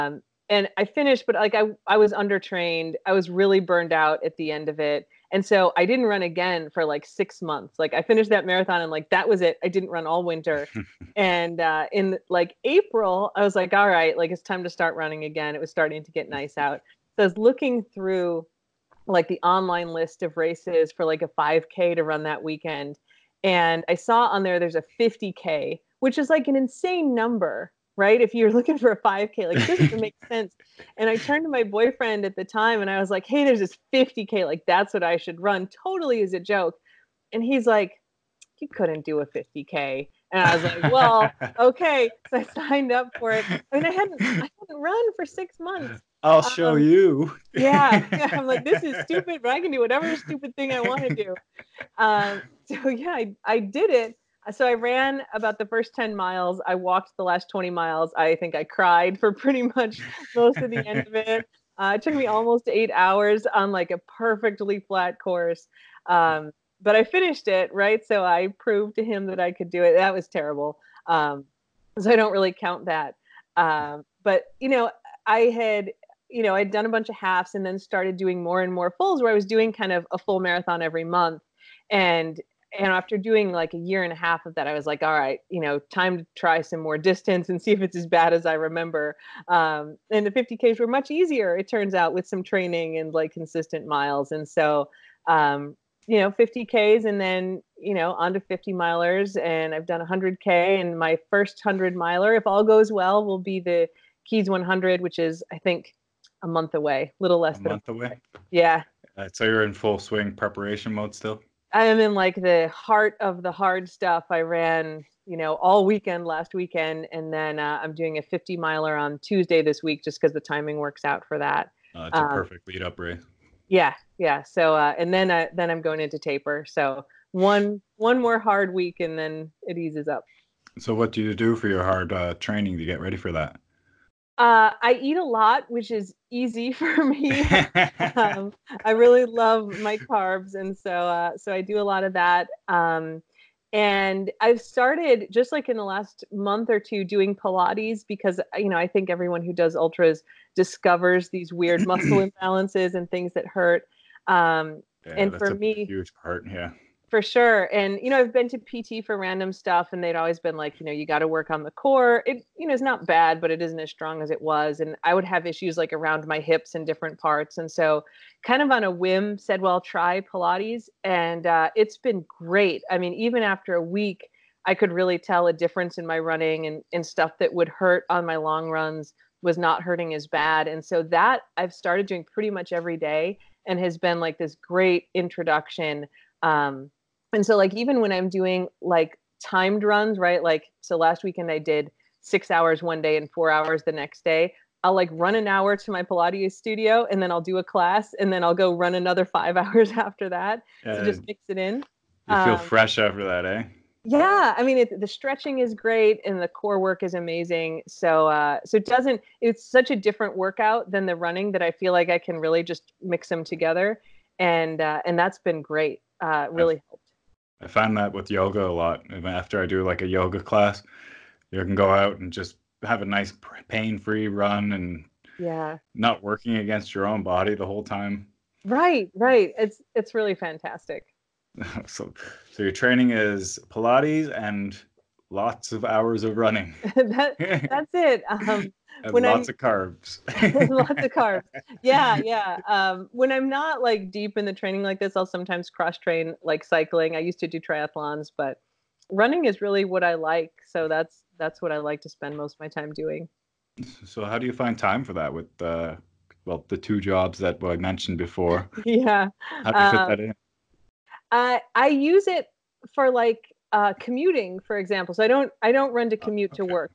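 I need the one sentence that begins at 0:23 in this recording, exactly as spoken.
And I saw on there there's a 50K, which is like an insane number right?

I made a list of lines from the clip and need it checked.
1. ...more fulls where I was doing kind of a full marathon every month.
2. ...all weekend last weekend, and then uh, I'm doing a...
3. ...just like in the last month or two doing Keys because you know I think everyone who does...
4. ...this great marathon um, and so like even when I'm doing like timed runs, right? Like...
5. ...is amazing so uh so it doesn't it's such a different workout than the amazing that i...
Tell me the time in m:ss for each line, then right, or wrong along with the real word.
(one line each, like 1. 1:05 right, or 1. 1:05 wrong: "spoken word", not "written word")
1. 1:18 right
2. 1:55 right
3. 2:25 wrong: "Pilates", not "Keys"
4. 3:04 wrong: "introduction", not "marathon"
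5. 3:27 wrong: "running", not "amazing".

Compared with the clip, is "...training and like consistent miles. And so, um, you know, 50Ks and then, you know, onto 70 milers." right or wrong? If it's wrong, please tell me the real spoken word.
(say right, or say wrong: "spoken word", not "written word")
wrong: "50", not "70".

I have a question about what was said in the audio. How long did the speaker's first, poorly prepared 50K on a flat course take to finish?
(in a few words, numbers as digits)
almost 8 hours.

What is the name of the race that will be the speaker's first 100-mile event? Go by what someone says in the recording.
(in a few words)
Keys 100.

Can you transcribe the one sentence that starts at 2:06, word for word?
So one one more hard week, and then it eases up.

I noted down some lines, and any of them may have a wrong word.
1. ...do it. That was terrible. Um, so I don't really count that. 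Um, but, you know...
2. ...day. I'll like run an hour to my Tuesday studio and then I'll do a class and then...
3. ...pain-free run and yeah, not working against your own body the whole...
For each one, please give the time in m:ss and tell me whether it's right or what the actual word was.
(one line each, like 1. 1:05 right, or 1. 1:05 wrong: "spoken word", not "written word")
1. 1:09 right
2. 3:14 wrong: "Pilates", not "Tuesday"
3. 3:43 right.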